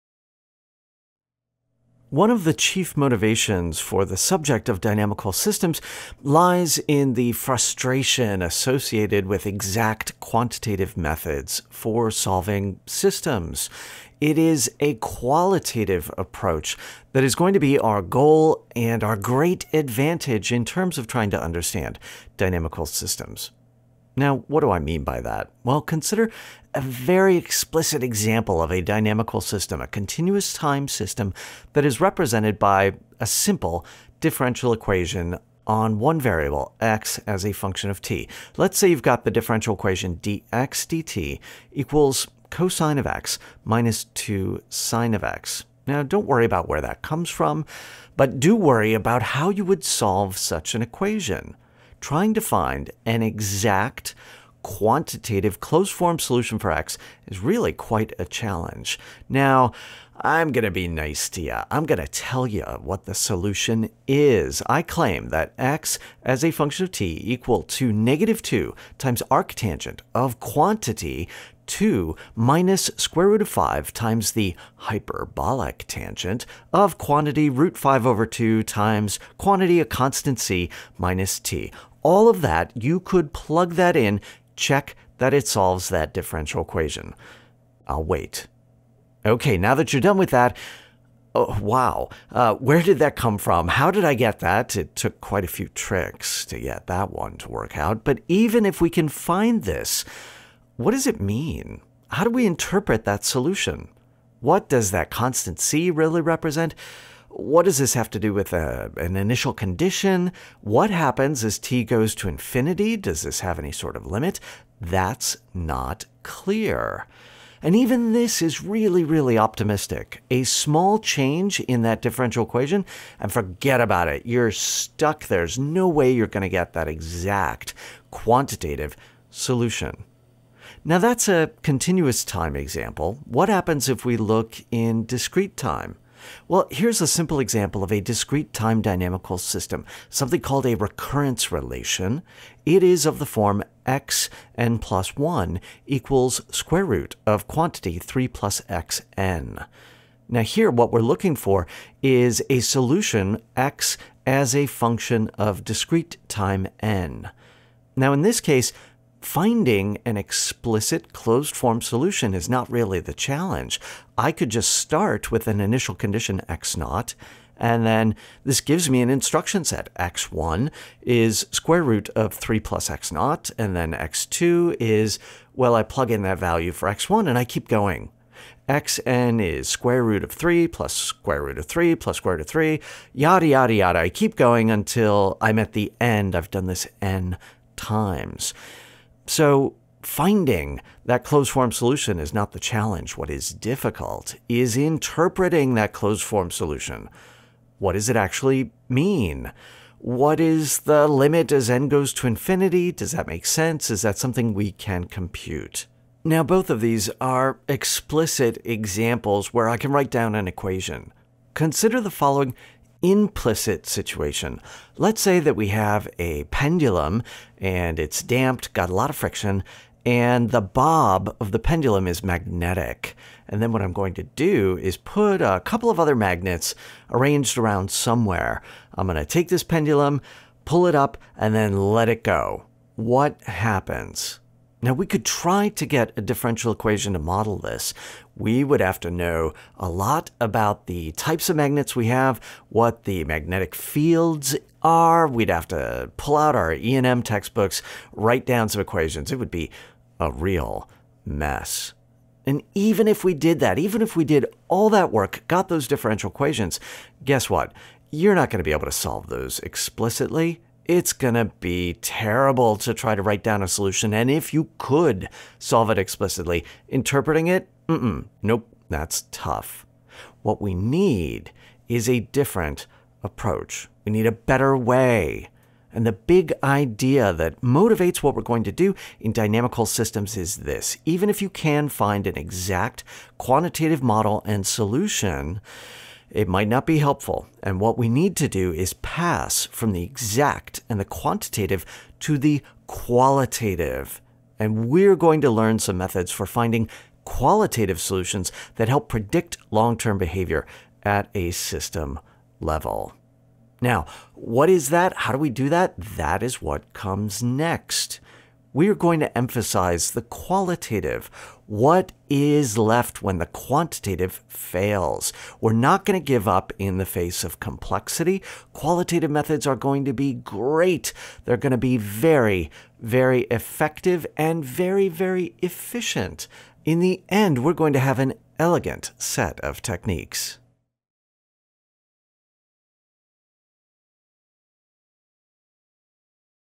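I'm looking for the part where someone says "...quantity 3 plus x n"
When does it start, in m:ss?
2:27.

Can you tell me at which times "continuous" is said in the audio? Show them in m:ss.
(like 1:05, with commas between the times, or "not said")
0:29, 2:11.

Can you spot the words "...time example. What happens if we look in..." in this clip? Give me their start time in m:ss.
2:12.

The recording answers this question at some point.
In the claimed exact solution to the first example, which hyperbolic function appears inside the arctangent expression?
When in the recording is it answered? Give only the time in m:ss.
1:14.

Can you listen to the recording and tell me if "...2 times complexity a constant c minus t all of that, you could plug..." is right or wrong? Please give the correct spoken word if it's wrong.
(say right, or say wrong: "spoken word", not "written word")
wrong: "quantity", not "complexity".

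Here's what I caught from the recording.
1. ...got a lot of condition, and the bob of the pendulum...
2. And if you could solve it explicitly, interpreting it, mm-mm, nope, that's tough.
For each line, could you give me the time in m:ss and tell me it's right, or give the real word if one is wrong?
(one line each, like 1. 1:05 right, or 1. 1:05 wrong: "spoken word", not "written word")
1. 3:38 wrong: "friction", not "condition"
2. 4:24 right.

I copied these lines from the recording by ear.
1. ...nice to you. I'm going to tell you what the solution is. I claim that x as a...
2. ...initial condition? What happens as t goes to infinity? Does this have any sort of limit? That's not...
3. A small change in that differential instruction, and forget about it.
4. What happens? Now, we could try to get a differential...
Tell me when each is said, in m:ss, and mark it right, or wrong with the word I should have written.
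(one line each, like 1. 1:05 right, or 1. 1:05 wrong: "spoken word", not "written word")
1. 1:00 right
2. 1:49 right
3. 2:00 wrong: "equation", not "instruction"
4. 3:52 right.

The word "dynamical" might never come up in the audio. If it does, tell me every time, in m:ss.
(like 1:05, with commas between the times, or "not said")
0:04, 0:22, 0:28, 2:18, 4:39.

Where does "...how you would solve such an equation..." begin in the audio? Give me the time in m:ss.
0:49.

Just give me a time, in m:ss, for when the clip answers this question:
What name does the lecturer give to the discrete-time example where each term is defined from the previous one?
2:20.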